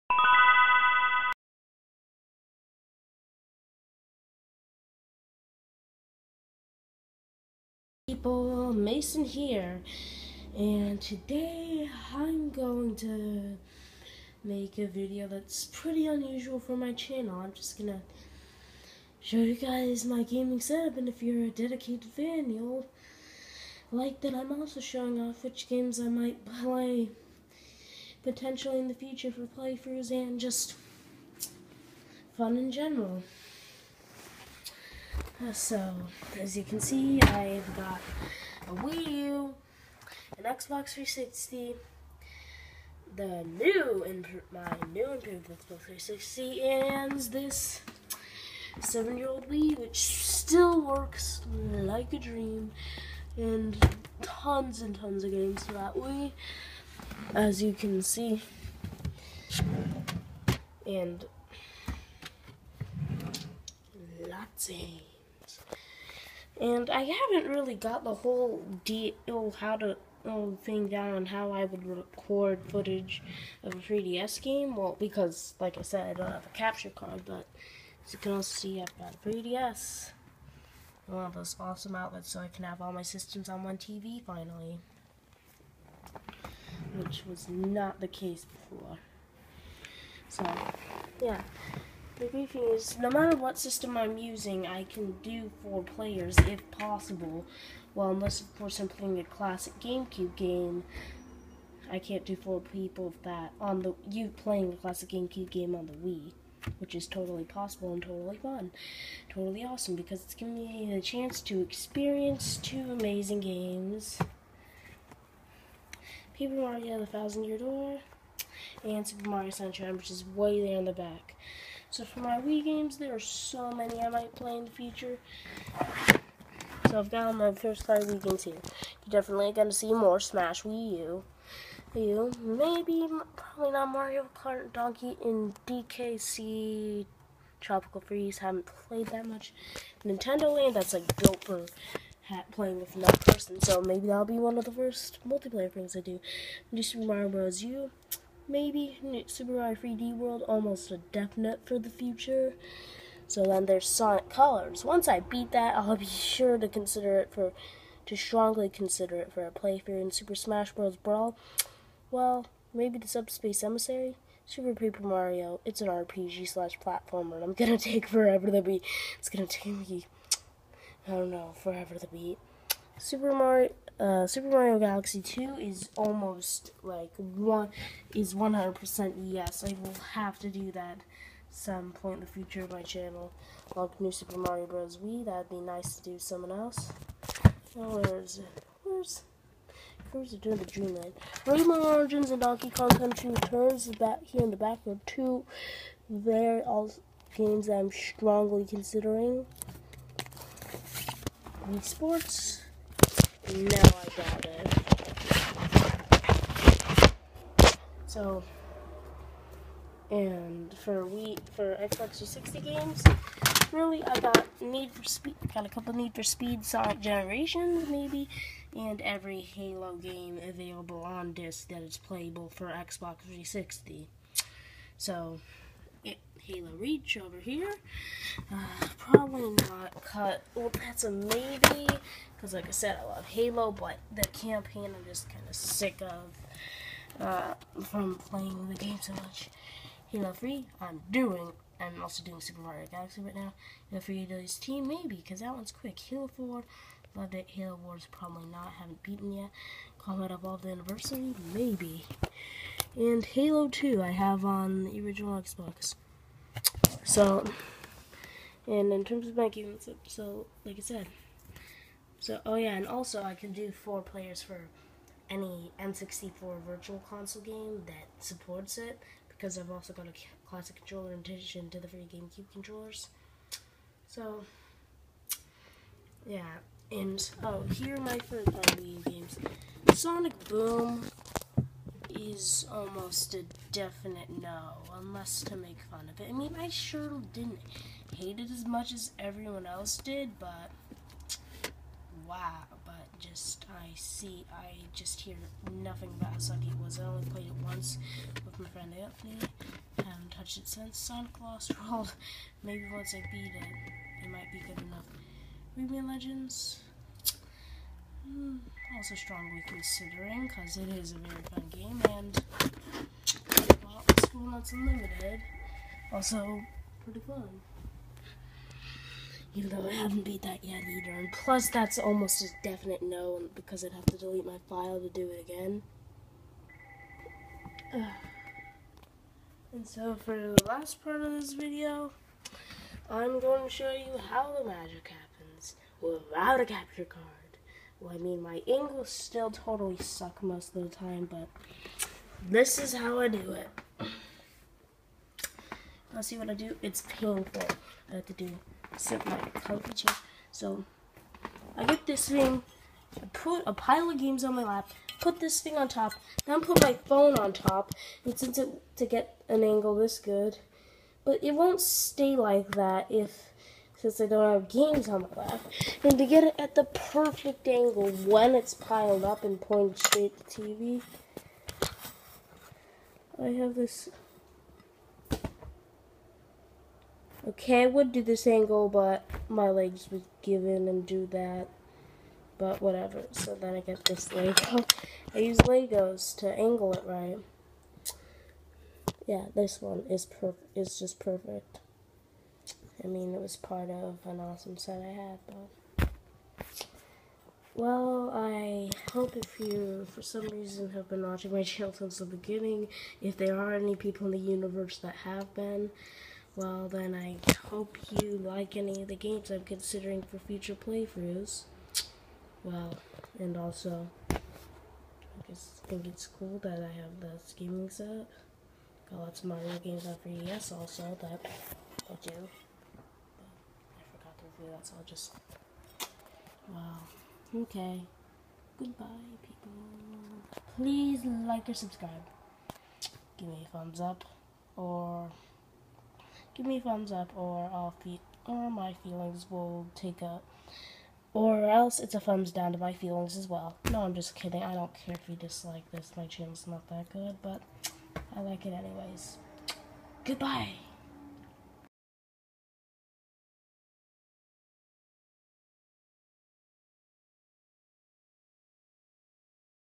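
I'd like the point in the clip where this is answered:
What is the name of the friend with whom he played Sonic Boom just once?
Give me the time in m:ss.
4:59.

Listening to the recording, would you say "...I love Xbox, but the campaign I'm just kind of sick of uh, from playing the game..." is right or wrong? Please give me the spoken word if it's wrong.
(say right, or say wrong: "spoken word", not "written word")
wrong: "Halo", not "Xbox".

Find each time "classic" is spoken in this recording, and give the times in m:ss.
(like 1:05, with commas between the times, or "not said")
1:39, 1:44, 4:30.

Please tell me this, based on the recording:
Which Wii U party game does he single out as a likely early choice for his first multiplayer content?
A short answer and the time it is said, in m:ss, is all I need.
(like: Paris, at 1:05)
Nintendo Land, at 2:20.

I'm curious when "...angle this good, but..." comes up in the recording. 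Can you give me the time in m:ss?
5:59.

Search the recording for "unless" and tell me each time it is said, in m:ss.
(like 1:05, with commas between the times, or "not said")
1:38, 4:44.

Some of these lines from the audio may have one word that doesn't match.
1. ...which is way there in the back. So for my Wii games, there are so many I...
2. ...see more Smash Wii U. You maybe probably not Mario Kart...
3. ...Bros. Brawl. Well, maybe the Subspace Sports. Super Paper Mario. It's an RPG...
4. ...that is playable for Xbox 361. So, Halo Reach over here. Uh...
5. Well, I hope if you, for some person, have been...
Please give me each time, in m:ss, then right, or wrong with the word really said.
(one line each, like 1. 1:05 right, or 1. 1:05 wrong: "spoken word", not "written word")
1. 1:59 right
2. 2:09 right
3. 2:40 wrong: "Emissary", not "Sports"
4. 3:41 wrong: "360", not "361"
5. 6:37 wrong: "reason", not "person".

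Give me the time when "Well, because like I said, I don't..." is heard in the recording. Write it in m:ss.
1:14.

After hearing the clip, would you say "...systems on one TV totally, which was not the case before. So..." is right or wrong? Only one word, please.
wrong.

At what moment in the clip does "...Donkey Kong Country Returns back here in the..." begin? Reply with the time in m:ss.
3:12.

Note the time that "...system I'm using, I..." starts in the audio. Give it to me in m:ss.
1:33.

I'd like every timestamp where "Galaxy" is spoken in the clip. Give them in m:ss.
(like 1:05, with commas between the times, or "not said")
2:54, 4:02.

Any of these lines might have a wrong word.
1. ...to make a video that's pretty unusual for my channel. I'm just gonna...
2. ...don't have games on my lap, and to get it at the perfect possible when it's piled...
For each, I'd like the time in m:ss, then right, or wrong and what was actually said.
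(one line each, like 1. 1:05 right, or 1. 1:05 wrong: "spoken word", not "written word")
1. 0:12 right
2. 6:04 wrong: "angle", not "possible".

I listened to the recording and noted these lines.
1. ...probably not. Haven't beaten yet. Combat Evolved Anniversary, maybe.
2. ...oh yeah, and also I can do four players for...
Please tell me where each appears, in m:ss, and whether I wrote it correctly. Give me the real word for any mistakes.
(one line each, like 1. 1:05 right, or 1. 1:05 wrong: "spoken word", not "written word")
1. 4:08 right
2. 4:22 right.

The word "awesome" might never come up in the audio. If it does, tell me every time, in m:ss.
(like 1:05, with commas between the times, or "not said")
1:21, 1:49, 6:34.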